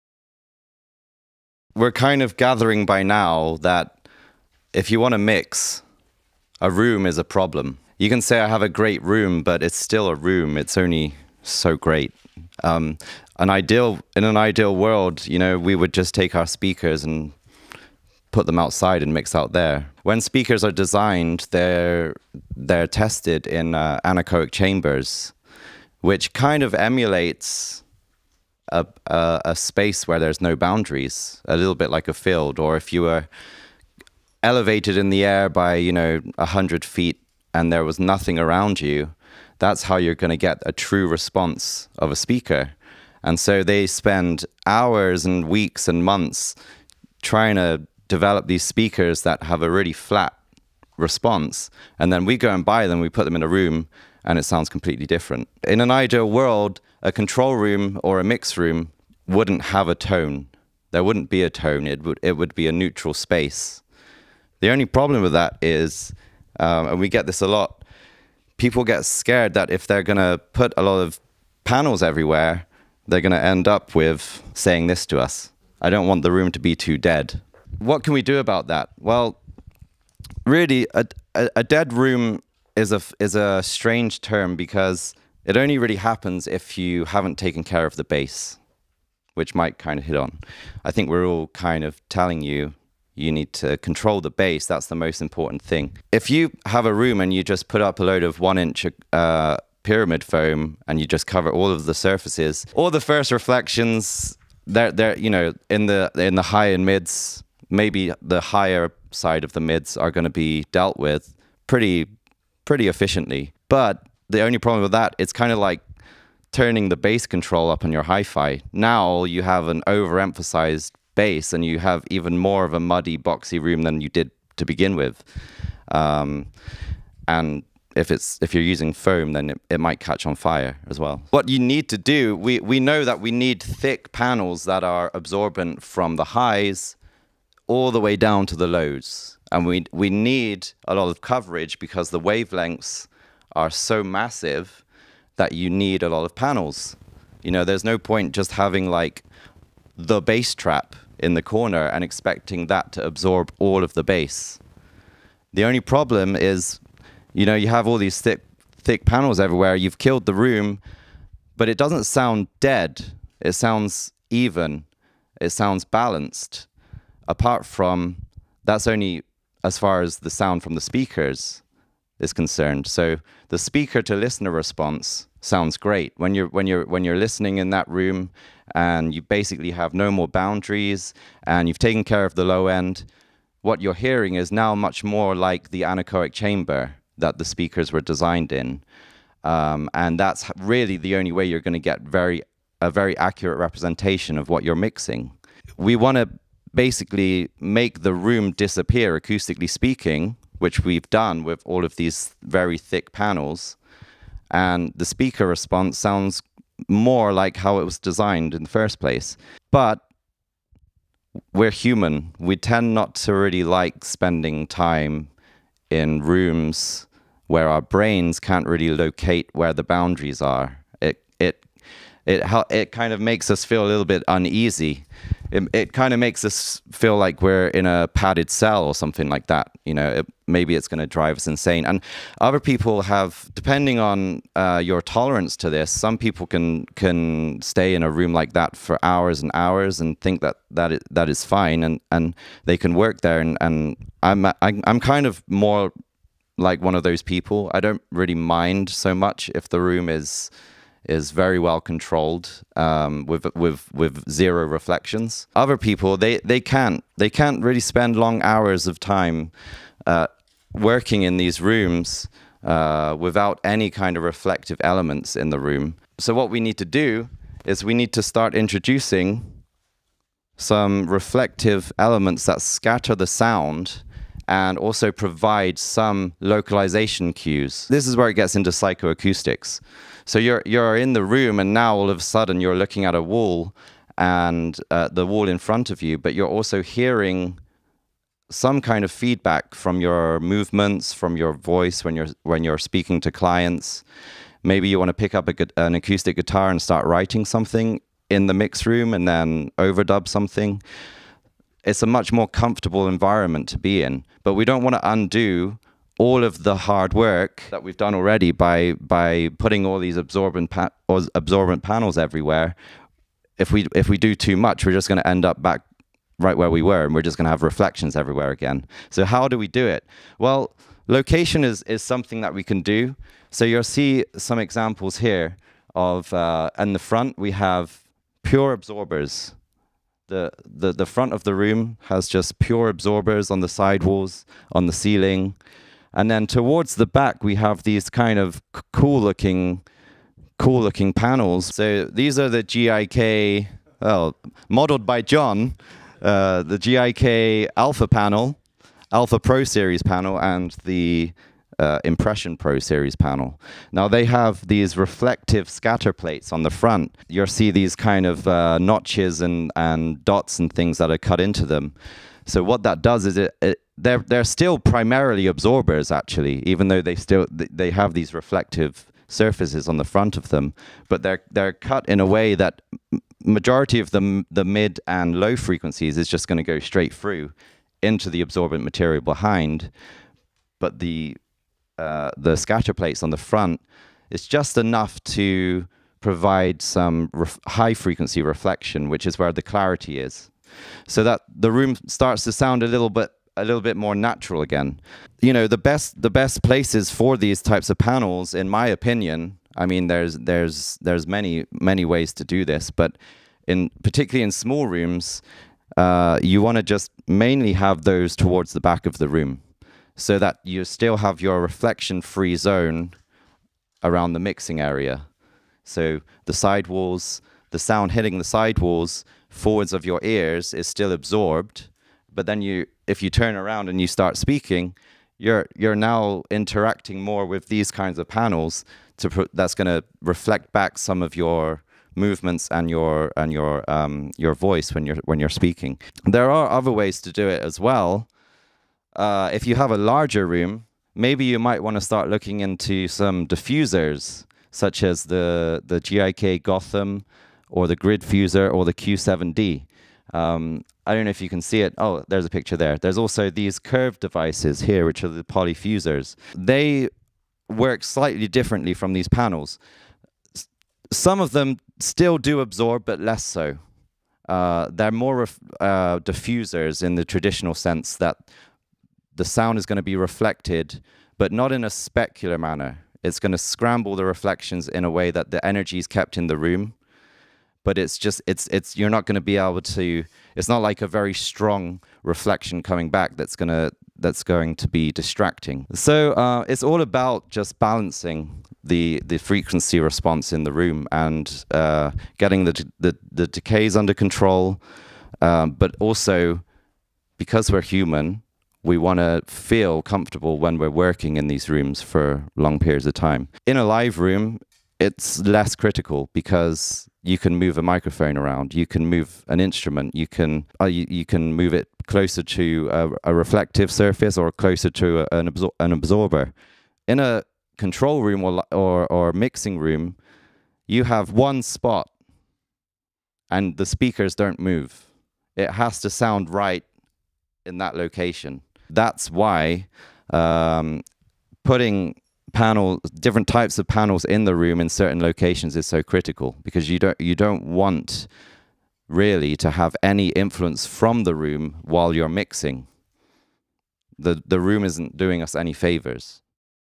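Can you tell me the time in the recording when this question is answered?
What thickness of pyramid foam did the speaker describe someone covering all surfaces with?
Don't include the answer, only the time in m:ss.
1:38.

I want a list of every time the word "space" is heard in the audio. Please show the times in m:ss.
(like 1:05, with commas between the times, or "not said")
0:29, 1:03.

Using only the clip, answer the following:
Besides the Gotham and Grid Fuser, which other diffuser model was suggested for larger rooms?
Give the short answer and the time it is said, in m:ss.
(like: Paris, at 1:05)
Q7D, at 7:28.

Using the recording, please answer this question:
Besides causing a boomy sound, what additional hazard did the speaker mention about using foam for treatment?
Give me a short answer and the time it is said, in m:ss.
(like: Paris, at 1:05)
catch on fire, at 2:09.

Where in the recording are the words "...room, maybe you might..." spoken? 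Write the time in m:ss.
7:20.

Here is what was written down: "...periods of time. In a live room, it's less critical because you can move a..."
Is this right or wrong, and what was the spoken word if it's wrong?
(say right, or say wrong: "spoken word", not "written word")
right.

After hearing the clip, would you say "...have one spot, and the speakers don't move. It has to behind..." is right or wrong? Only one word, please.
wrong.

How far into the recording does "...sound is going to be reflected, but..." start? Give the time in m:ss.
7:49.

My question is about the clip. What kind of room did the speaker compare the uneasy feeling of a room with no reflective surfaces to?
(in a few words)
padded cell.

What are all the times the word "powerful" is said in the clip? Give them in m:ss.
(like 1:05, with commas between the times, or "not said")
not said.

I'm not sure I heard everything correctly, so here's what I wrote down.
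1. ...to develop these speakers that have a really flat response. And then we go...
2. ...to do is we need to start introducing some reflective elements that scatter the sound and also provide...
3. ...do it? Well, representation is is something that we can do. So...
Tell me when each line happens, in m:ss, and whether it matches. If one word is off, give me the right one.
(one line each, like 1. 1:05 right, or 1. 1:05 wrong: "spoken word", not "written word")
1. 0:47 right
2. 4:26 right
3. 5:19 wrong: "location", not "representation".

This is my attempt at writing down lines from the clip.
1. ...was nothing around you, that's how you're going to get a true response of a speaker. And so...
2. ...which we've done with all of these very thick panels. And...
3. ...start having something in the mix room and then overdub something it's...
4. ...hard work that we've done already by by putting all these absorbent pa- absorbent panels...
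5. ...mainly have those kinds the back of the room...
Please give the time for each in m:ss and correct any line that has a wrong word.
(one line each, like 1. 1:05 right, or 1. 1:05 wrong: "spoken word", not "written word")
1. 0:37 right
2. 3:20 right
3. 4:56 wrong: "writing", not "having"
4. 5:06 right
5. 6:47 wrong: "towards", not "kinds".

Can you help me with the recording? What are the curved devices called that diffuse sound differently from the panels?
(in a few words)
polyfusers.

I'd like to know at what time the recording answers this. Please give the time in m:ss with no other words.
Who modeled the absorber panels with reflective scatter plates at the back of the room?
5:45.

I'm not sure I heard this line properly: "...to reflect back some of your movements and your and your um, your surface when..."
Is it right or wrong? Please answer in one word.
wrong.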